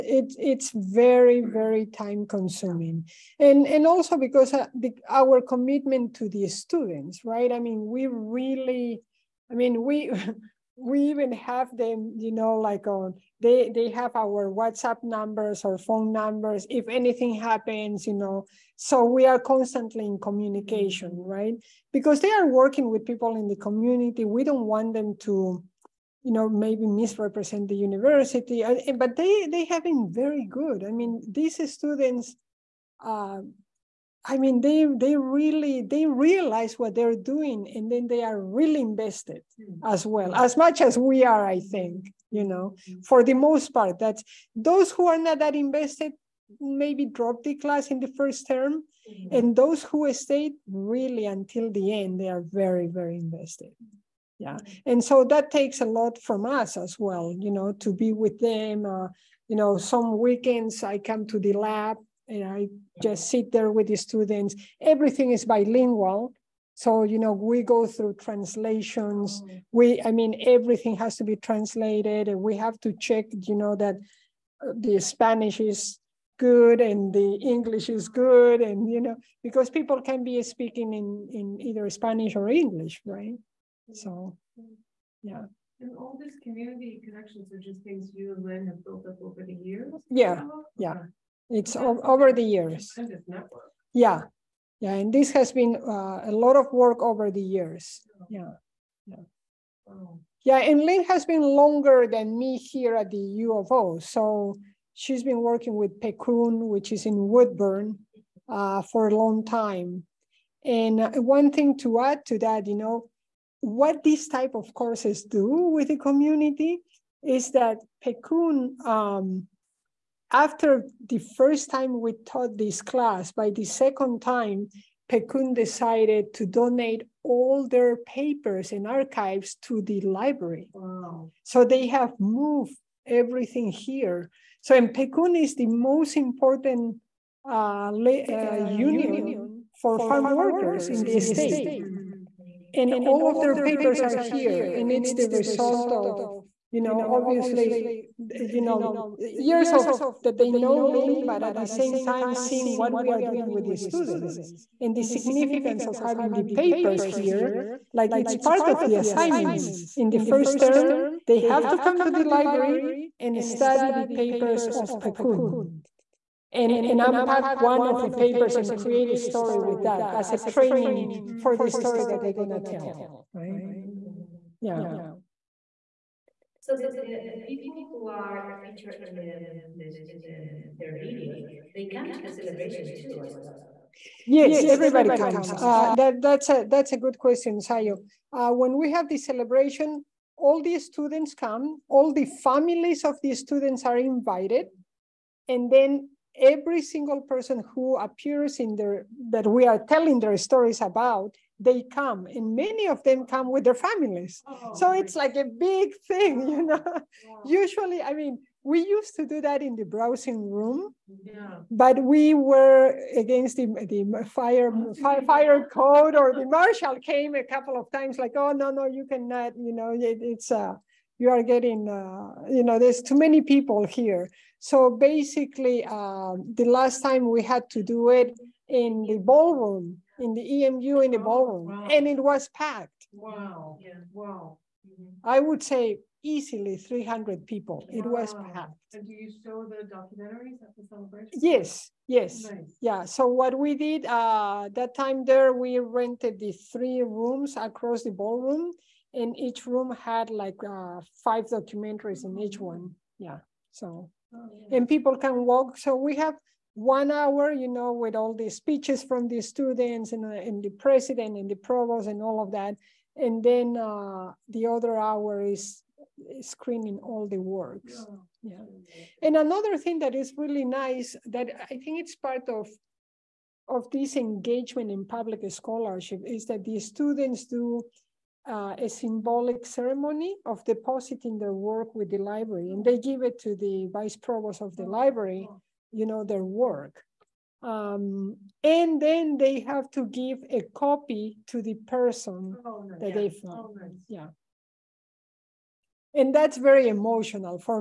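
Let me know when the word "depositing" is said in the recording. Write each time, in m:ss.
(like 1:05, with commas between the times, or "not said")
4:40.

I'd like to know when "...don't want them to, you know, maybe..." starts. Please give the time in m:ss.
0:24.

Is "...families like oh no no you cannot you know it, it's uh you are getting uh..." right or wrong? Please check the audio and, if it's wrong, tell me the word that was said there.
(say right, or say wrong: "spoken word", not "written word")
wrong: "times", not "families".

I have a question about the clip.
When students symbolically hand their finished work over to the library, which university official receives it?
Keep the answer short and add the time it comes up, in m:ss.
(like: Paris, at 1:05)
vice provost, at 4:43.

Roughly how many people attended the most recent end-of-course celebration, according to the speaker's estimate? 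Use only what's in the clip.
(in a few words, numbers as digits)
300.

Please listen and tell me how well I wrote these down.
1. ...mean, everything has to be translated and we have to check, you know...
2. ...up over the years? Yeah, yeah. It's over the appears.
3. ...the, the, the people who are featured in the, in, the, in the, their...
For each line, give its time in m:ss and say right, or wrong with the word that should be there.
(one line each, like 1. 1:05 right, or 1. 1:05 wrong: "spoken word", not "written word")
1. 1:10 right
2. 1:29 wrong: "years", not "appears"
3. 2:56 right.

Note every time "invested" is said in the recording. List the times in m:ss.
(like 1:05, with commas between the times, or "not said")
0:38, 0:45, 0:53.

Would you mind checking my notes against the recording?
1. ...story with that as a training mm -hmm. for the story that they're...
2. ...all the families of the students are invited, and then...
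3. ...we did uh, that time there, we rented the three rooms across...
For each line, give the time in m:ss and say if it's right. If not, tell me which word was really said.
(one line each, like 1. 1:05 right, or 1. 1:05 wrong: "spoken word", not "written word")
1. 2:49 right
2. 3:11 right
3. 4:03 right.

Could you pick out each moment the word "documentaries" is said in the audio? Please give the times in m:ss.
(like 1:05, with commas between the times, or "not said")
3:59, 4:11.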